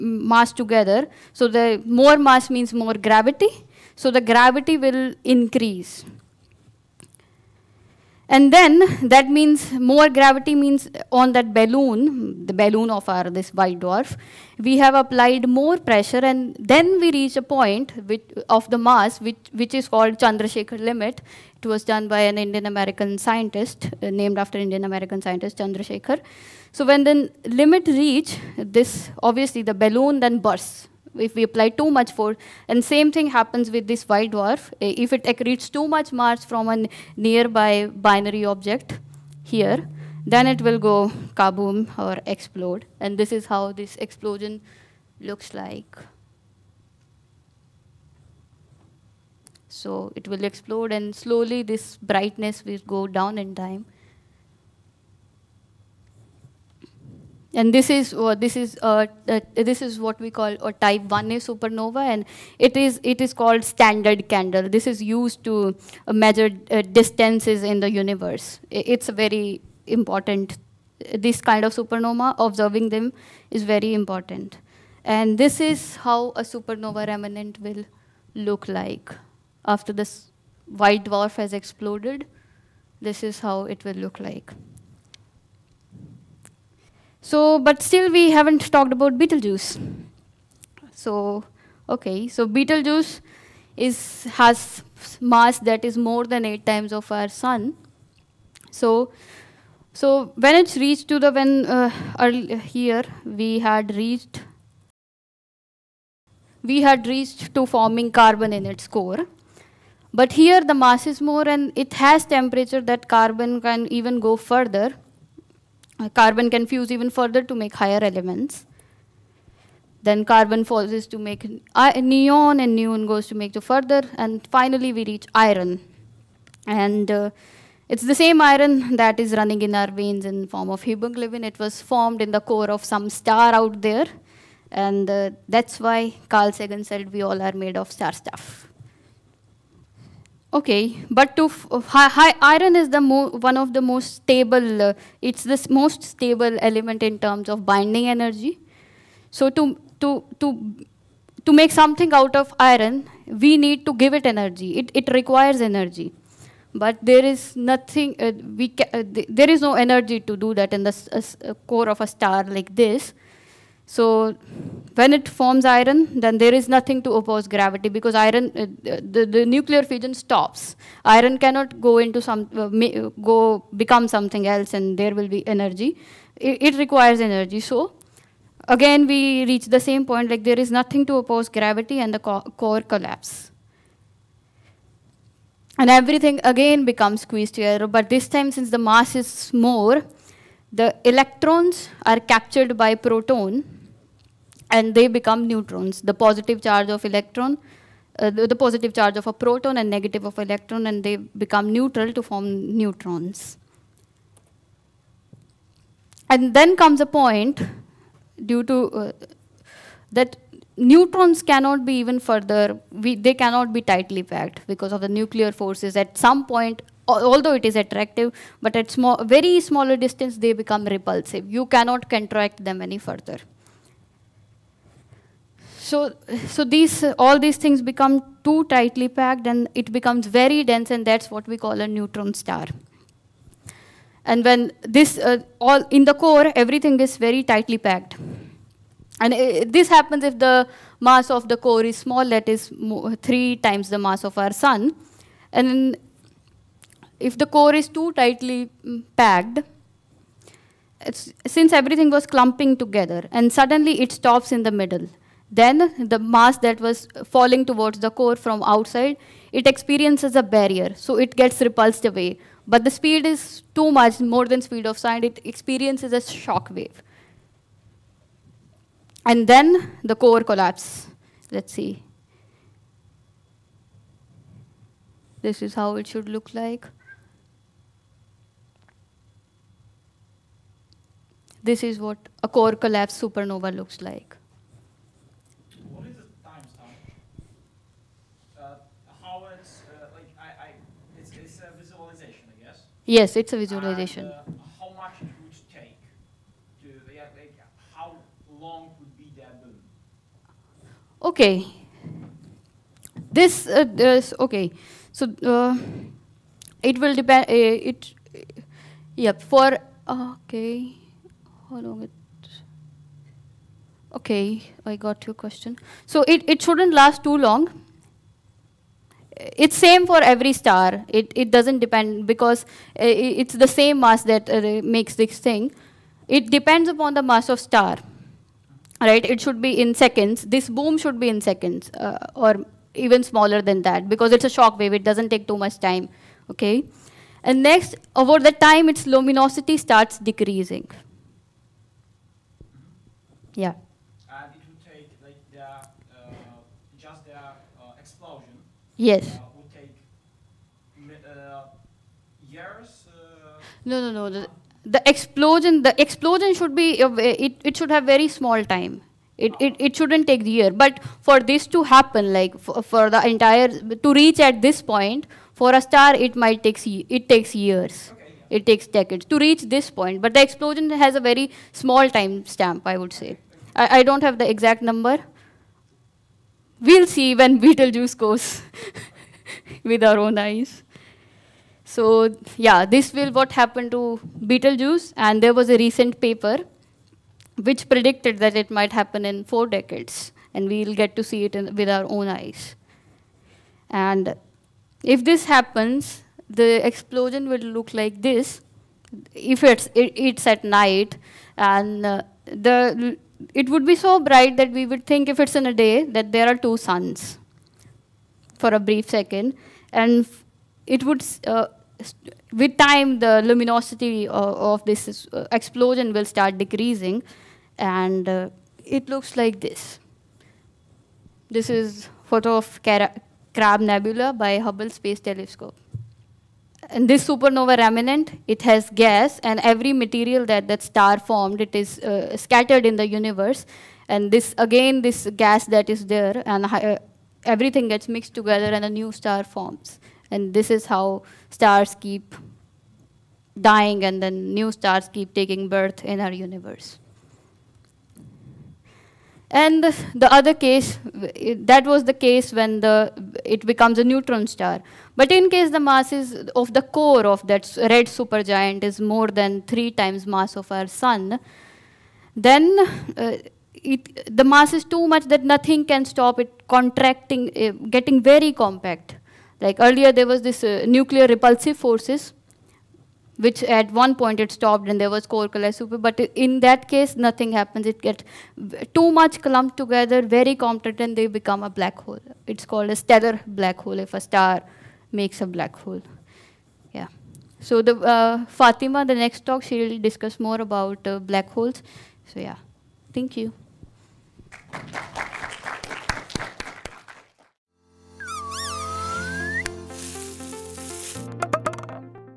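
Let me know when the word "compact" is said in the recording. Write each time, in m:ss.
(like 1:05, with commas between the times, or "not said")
7:48, 8:00.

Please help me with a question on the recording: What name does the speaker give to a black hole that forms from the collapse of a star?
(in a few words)
stellar black hole.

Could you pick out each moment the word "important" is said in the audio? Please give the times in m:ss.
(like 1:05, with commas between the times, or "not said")
1:09, 1:14.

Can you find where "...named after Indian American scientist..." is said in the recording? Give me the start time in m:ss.
0:24.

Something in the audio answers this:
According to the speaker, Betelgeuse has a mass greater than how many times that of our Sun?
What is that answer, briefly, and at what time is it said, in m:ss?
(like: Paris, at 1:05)
8, at 1:36.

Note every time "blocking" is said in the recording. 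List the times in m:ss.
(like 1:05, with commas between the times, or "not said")
not said.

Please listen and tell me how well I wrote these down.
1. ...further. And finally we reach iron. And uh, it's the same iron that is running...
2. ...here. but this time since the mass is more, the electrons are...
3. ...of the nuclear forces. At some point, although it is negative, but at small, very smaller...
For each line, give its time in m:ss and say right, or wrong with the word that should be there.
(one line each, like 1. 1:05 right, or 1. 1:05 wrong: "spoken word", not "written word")
1. 2:03 right
2. 3:07 right
3. 3:34 wrong: "attractive", not "negative".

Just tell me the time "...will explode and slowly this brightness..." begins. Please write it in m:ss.
0:50.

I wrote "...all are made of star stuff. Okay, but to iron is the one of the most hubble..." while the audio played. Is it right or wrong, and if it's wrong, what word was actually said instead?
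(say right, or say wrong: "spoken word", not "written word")
wrong: "stable", not "hubble".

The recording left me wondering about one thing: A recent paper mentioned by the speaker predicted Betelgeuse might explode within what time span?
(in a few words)
4 decades.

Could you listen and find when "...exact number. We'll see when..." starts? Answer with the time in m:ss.
6:14.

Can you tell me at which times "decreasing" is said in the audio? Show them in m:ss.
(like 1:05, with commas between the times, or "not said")
5:40, 6:56.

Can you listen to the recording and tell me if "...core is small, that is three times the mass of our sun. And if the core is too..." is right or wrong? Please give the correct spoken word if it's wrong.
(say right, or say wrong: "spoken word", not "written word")
right.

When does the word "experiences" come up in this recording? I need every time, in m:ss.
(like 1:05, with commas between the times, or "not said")
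4:19, 4:25.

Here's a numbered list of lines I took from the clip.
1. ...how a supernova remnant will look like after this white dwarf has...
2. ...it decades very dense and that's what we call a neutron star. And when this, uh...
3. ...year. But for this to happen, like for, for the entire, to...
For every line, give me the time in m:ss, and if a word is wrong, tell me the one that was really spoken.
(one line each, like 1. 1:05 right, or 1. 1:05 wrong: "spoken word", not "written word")
1. 1:16 right
2. 3:49 wrong: "becomes", not "decades"
3. 6:00 right.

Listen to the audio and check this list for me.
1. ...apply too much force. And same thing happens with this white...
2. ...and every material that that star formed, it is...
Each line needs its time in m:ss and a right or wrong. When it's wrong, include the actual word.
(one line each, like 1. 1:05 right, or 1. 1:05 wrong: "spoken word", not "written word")
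1. 0:31 right
2. 7:09 right.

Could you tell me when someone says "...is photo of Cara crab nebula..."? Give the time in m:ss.
7:01.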